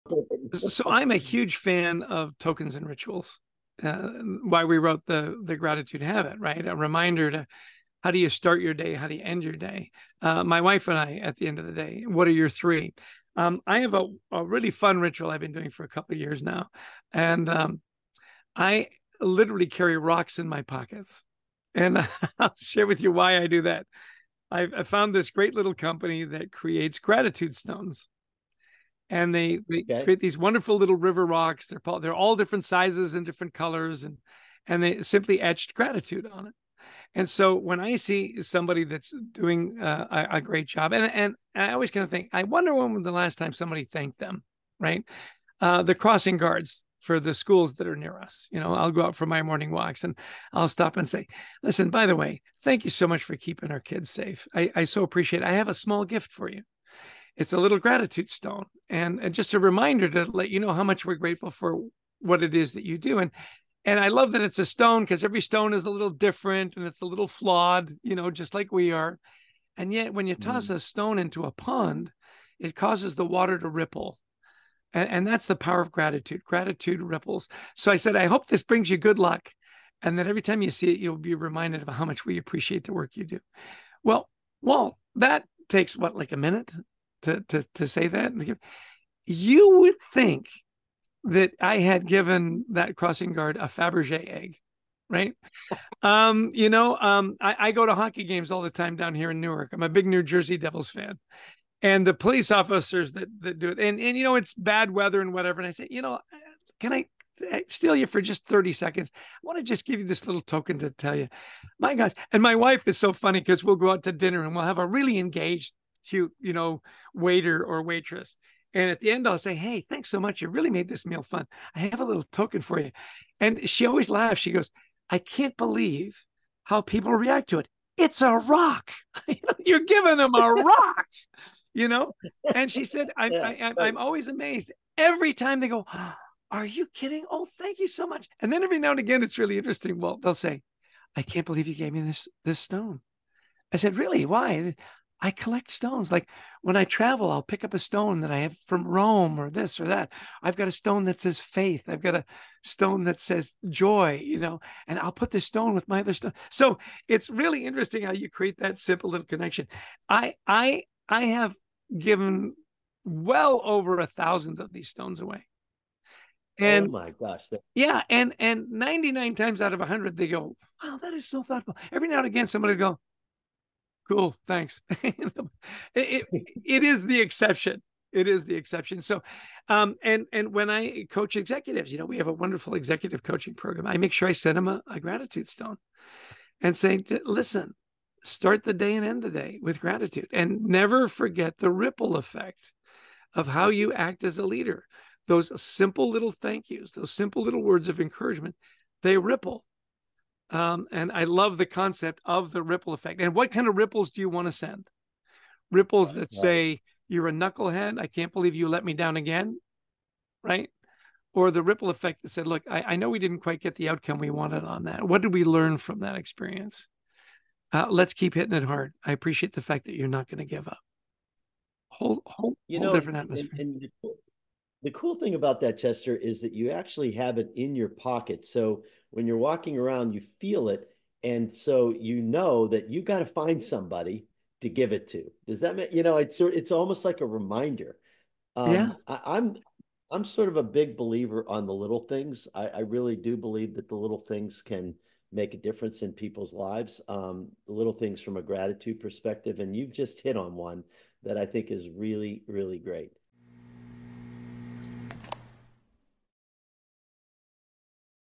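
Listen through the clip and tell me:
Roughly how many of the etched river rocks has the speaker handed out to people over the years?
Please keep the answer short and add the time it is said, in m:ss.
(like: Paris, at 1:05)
over 1000, at 2:43.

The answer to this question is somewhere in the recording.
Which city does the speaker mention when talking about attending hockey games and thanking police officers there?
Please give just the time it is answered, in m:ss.
1:39.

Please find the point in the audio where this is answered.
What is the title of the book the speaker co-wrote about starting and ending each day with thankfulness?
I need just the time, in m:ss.
0:05.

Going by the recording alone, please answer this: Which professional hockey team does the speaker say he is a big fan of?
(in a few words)
New Jersey Devils.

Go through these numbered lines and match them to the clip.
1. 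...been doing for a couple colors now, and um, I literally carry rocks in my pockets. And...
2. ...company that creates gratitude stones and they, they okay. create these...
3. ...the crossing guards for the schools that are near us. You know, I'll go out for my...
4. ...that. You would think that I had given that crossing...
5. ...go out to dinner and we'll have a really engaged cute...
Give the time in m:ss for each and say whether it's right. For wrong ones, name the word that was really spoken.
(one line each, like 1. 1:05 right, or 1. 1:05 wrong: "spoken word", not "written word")
1. 0:15 wrong: "years", not "colors"
2. 0:25 right
3. 0:45 right
4. 1:28 right
5. 1:53 right.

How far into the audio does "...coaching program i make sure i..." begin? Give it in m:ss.
3:03.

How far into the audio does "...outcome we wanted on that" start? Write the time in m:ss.
3:33.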